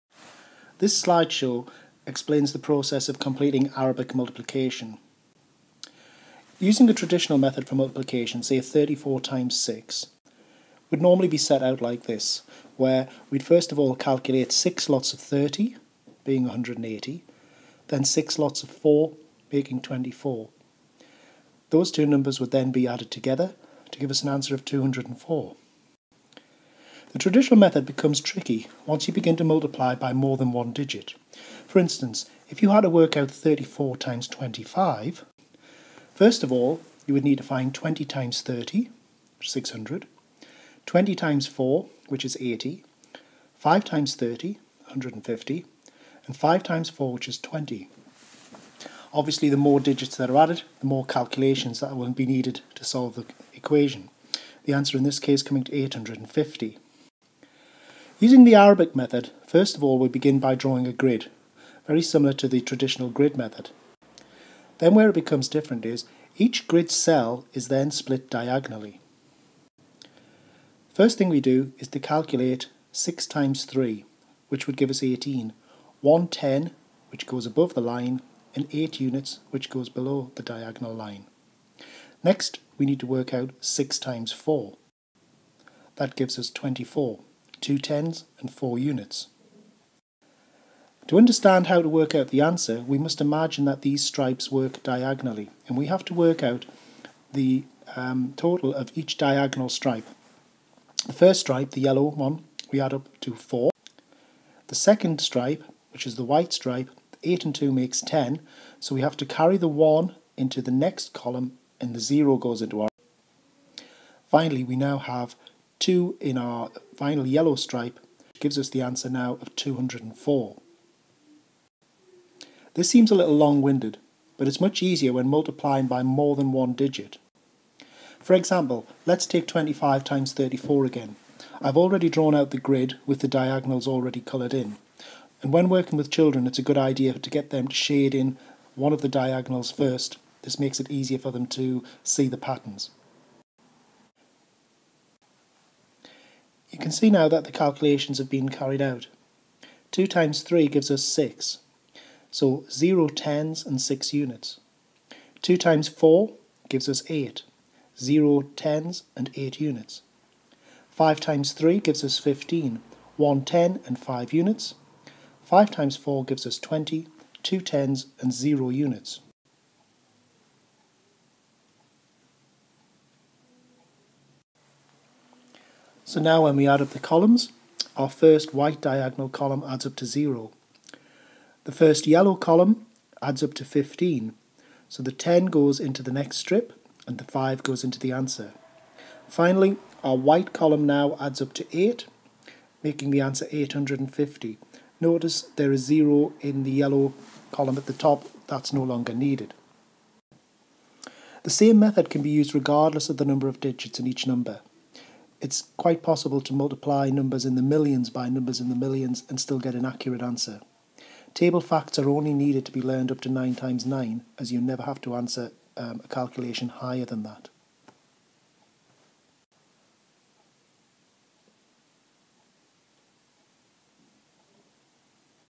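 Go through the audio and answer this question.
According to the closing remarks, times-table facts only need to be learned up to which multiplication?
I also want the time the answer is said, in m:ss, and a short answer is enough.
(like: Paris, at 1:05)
9 times 9, at 3:33.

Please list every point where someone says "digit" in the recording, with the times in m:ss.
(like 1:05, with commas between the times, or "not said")
0:30, 0:49, 2:06, 3:23.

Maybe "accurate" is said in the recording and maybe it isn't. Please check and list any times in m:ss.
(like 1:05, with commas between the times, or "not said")
3:29.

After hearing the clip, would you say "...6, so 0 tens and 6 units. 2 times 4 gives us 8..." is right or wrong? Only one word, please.
right.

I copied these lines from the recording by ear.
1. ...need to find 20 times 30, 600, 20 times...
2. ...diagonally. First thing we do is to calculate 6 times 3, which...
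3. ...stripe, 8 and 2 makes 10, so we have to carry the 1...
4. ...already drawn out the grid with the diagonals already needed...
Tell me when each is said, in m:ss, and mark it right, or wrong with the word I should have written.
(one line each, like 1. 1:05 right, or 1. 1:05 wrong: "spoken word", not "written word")
1. 0:37 right
2. 1:08 right
3. 1:46 right
4. 2:11 wrong: "coloured", not "needed".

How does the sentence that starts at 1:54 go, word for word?
Finally, we now have 2 in our final yellow stripe, gives us the answer now of 204.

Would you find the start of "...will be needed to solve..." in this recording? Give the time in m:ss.
0:51.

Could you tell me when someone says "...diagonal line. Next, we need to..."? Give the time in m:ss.
1:20.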